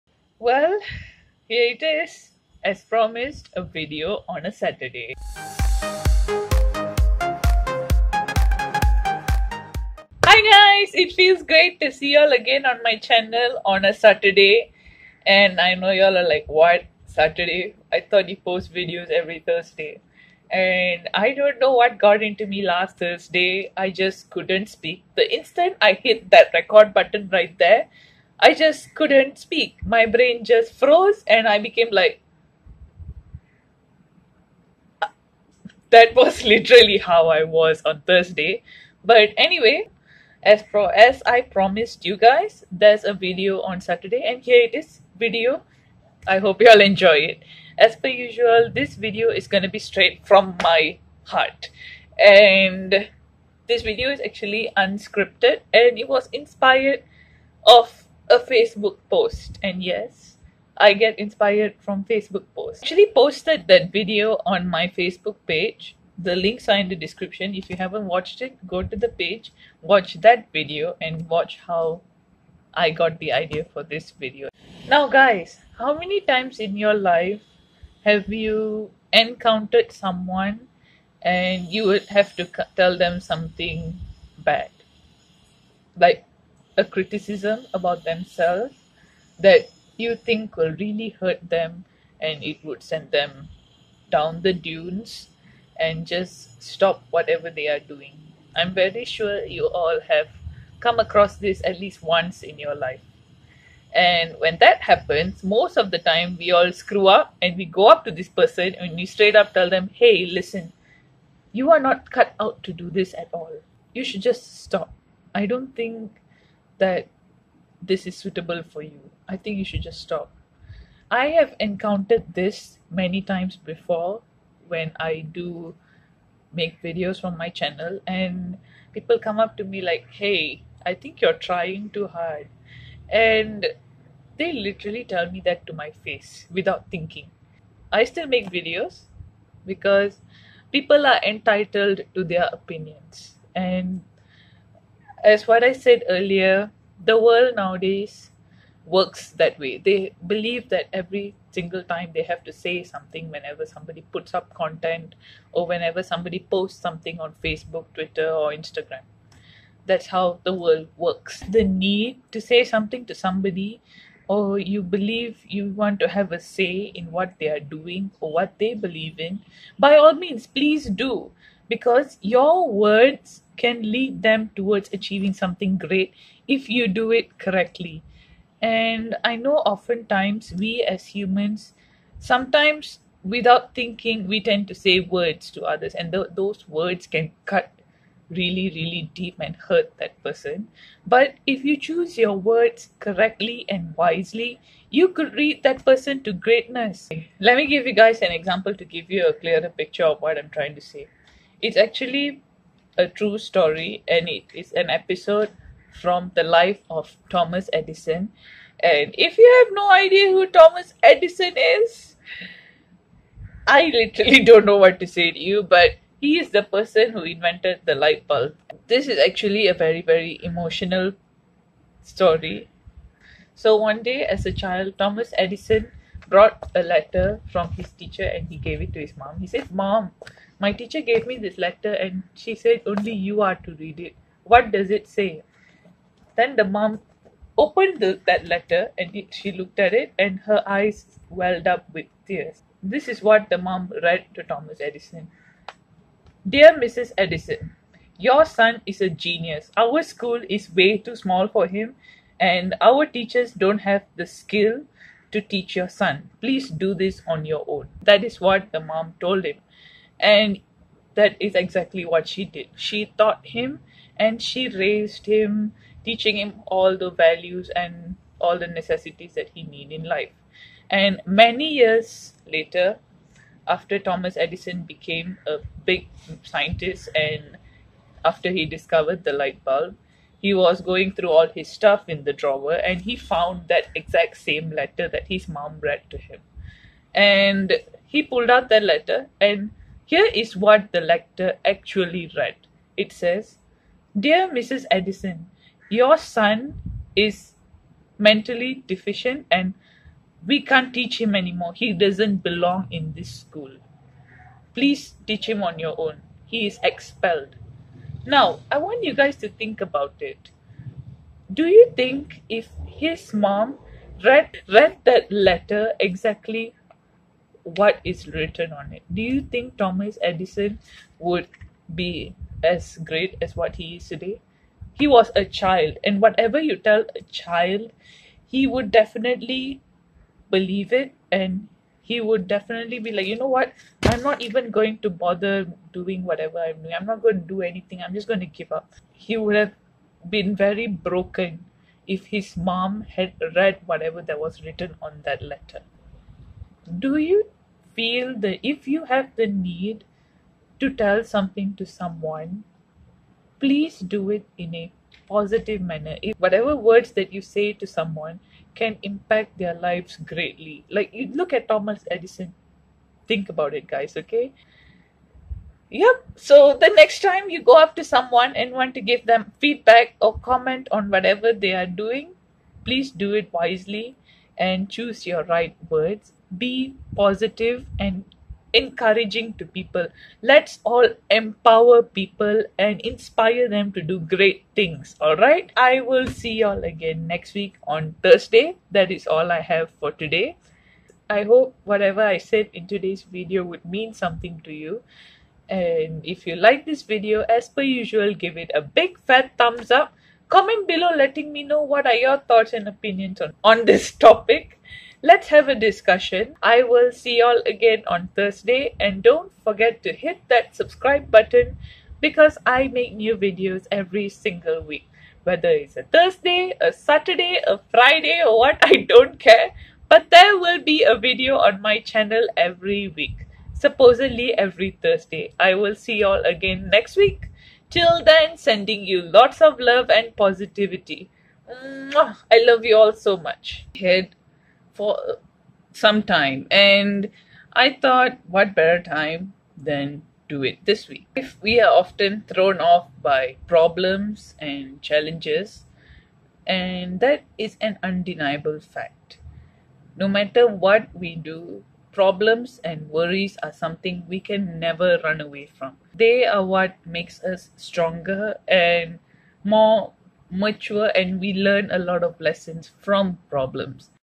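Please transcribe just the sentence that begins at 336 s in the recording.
I'm not going to do anything.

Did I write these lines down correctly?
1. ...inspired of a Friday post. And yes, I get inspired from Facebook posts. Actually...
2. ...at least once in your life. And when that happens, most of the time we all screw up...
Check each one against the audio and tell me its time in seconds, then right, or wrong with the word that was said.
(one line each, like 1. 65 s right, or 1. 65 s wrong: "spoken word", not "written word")
1. 56 s wrong: "Facebook", not "Friday"
2. 101 s right.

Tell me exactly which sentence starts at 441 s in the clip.
If we are often thrown off by problems and challenges, and that is an undeniable fact.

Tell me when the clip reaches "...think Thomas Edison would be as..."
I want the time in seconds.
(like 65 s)
319 s.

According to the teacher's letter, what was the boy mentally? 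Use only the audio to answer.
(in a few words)
mentally deficient.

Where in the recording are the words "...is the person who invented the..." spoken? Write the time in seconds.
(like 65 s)
216 s.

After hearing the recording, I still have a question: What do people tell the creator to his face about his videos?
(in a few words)
trying too hard.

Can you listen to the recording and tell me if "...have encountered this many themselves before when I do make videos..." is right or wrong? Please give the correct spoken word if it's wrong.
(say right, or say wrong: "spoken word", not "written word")
wrong: "times", not "themselves".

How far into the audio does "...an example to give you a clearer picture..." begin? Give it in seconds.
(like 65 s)
198 s.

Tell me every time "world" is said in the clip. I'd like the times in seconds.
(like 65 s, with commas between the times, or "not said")
147 s, 160 s.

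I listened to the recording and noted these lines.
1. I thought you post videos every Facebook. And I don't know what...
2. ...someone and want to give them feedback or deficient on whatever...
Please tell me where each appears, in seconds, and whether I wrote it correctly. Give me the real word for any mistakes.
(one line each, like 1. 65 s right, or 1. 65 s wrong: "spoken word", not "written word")
1. 17 s wrong: "Thursday", not "Facebook"
2. 368 s wrong: "comment", not "deficient".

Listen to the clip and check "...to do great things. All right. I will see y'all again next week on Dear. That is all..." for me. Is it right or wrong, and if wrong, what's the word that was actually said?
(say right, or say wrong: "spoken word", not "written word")
wrong: "Thursday", not "Dear".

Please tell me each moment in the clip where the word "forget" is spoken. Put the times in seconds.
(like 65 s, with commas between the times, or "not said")
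409 s.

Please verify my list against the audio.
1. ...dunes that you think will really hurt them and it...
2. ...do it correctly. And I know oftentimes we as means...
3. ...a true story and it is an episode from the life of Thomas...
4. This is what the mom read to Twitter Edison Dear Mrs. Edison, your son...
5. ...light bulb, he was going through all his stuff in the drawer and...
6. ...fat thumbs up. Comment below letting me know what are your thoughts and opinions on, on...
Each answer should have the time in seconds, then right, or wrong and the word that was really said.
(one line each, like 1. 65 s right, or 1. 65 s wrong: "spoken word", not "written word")
1. 88 s wrong: "themselves", not "dunes"
2. 176 s wrong: "humans", not "means"
3. 202 s right
4. 242 s wrong: "Thomas", not "Twitter"
5. 279 s right
6. 399 s right.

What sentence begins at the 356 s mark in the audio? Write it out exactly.
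If whatever words that you say to someone can impact their lives greatly.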